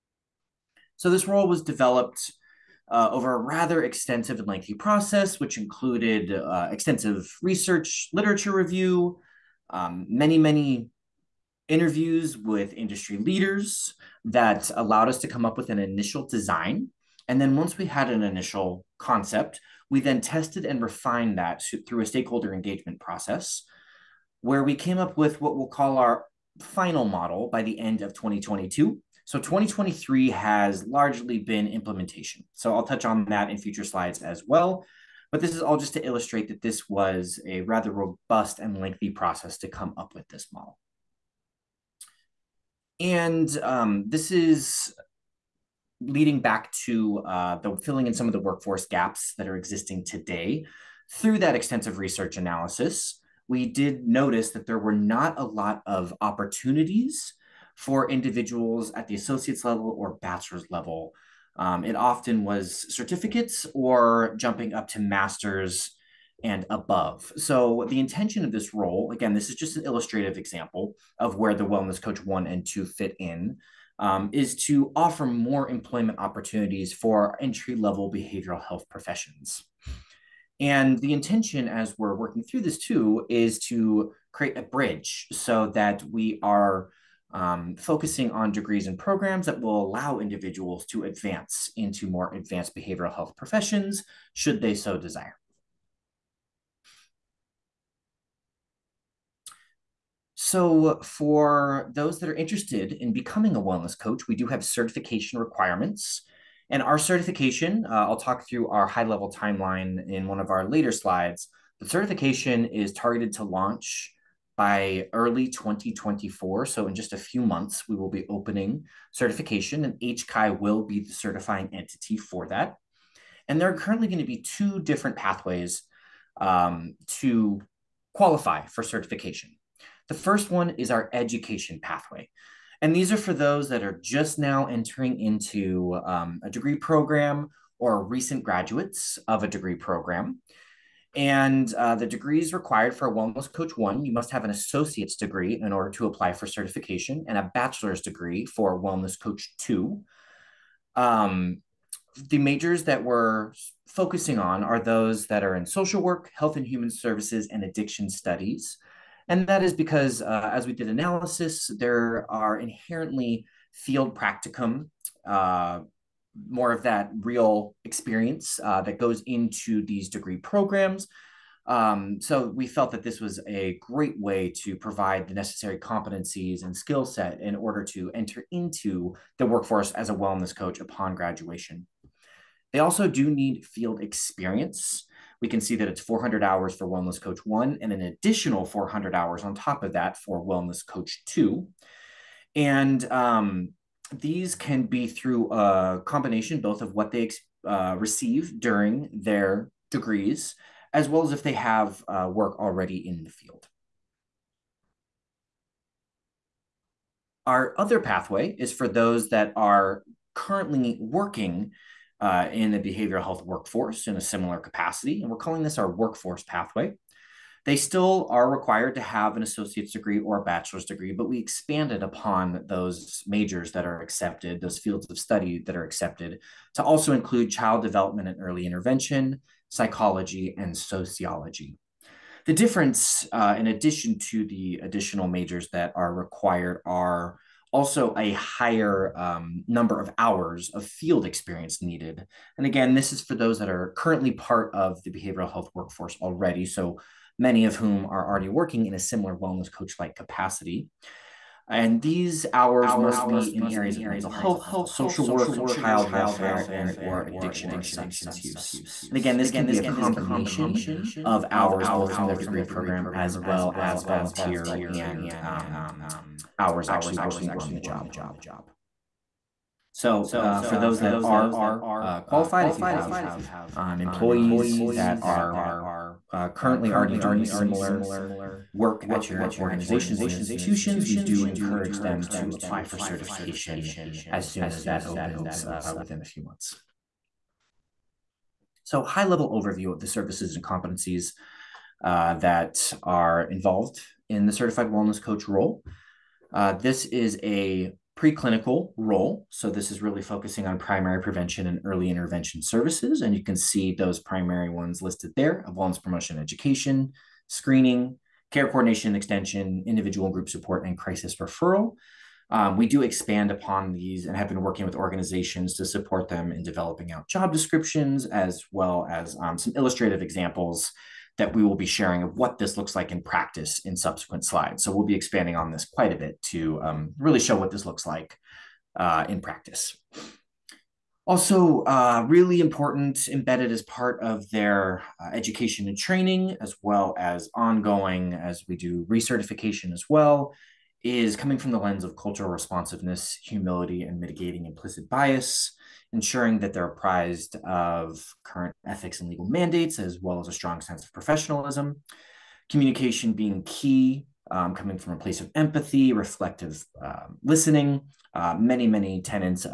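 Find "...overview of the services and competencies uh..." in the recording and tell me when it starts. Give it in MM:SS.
04:49.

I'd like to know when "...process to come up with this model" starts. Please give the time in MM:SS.
00:39.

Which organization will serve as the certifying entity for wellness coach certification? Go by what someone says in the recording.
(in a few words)
HCI.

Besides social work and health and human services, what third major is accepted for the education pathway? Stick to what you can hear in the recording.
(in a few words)
Addiction studies.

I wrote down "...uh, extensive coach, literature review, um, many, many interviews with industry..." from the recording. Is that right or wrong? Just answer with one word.
wrong.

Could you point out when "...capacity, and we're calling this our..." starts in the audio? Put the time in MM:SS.
03:34.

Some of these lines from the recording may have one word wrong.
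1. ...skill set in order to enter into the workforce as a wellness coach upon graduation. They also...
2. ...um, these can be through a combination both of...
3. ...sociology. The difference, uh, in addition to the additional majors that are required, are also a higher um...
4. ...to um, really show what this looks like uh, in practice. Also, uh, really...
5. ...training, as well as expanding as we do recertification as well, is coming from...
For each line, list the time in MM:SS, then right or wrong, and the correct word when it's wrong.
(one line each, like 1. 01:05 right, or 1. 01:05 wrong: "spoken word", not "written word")
1. 02:56 right
2. 03:13 right
3. 03:50 right
4. 05:26 right
5. 05:35 wrong: "ongoing", not "expanding".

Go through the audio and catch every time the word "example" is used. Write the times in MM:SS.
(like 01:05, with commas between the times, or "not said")
01:10, 05:20.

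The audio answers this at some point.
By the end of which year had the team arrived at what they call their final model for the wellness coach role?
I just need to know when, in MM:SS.
00:28.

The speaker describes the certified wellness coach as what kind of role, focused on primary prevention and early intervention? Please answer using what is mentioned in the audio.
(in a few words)
Preclinical.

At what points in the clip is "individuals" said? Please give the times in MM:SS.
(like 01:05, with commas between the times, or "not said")
00:58, 01:30, 05:09.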